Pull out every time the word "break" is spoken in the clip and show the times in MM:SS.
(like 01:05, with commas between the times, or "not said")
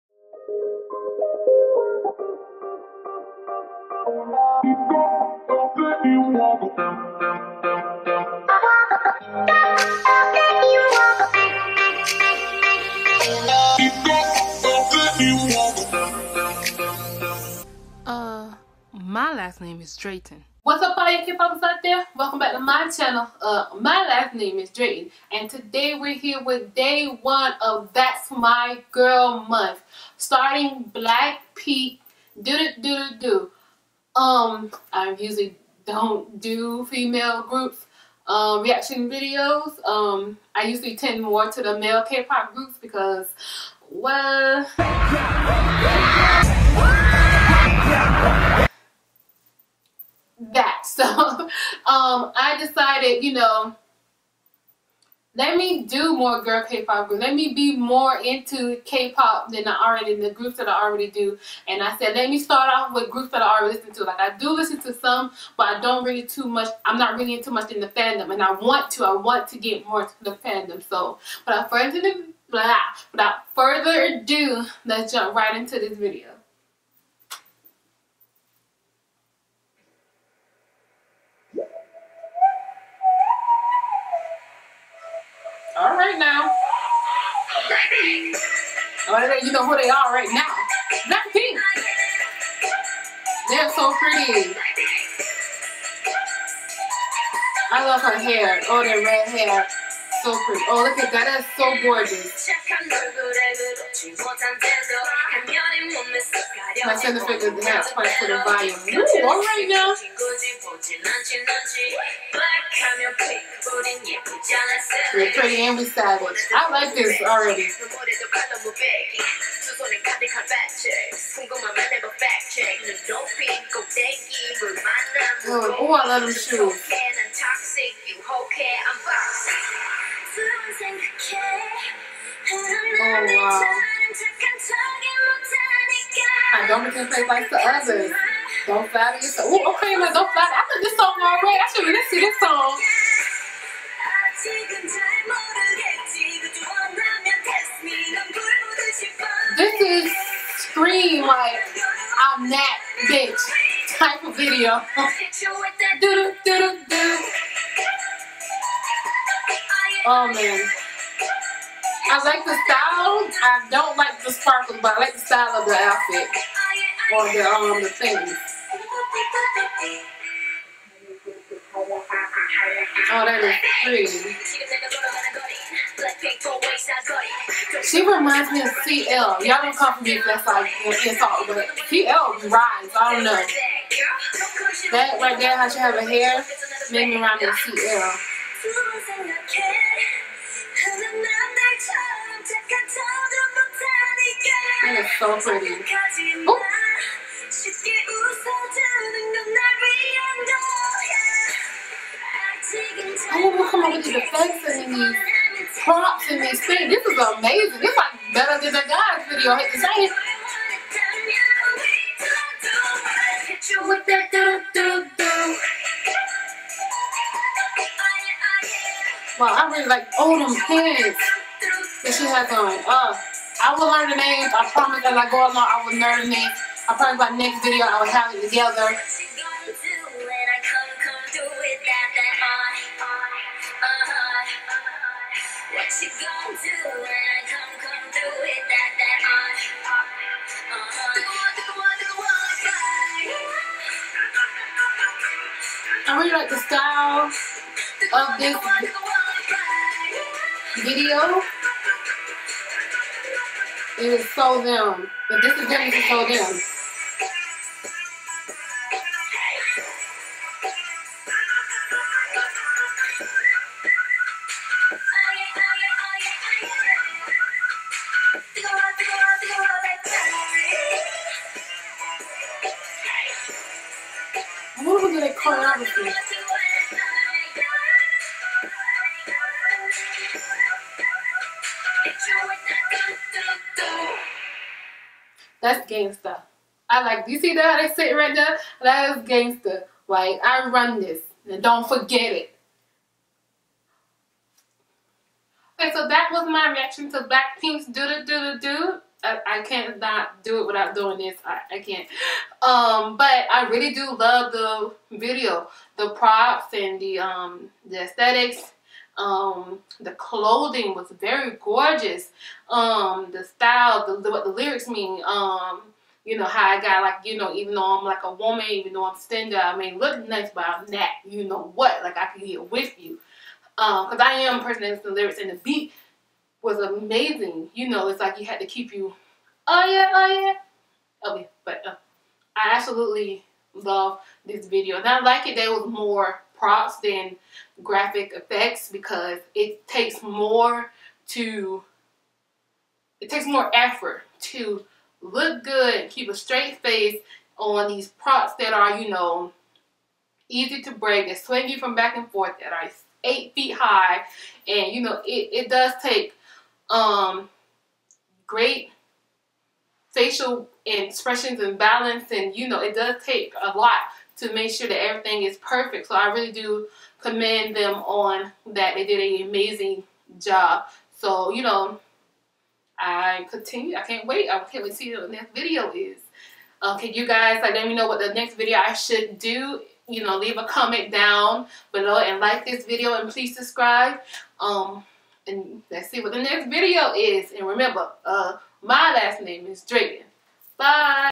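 05:50.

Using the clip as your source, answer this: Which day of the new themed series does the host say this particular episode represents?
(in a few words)
Day one.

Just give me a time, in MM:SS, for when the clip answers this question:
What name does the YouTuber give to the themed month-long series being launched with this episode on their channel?
00:27.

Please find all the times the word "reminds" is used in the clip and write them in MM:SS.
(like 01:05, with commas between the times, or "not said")
02:58, 03:07.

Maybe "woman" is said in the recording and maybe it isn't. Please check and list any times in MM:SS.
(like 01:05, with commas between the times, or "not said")
05:18.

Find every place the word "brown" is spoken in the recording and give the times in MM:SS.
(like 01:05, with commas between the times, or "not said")
not said.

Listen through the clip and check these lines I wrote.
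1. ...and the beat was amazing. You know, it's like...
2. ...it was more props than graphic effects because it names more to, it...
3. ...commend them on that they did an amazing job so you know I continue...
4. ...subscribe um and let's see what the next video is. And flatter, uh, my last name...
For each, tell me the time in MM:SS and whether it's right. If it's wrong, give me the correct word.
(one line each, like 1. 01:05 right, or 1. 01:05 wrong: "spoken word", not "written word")
1. 05:25 right
2. 05:35 wrong: "takes", not "names"
3. 06:07 right
4. 06:23 wrong: "remember", not "flatter".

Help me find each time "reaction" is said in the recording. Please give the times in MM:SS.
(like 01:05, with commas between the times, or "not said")
00:38, 04:56.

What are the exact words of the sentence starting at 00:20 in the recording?
What's up all you K-popers out there?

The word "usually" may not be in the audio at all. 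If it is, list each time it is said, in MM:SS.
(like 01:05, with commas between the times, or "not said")
00:35, 00:40.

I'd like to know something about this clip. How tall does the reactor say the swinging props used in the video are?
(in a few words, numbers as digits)
8 feet.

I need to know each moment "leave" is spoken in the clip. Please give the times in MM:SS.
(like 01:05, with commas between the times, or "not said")
06:20.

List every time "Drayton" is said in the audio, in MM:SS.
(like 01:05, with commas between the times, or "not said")
00:19, 00:24, 06:29.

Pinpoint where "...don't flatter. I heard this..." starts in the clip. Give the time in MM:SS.
02:20.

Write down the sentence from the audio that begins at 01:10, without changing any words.
So, without further, blah, without further ado, let's jump right into this video.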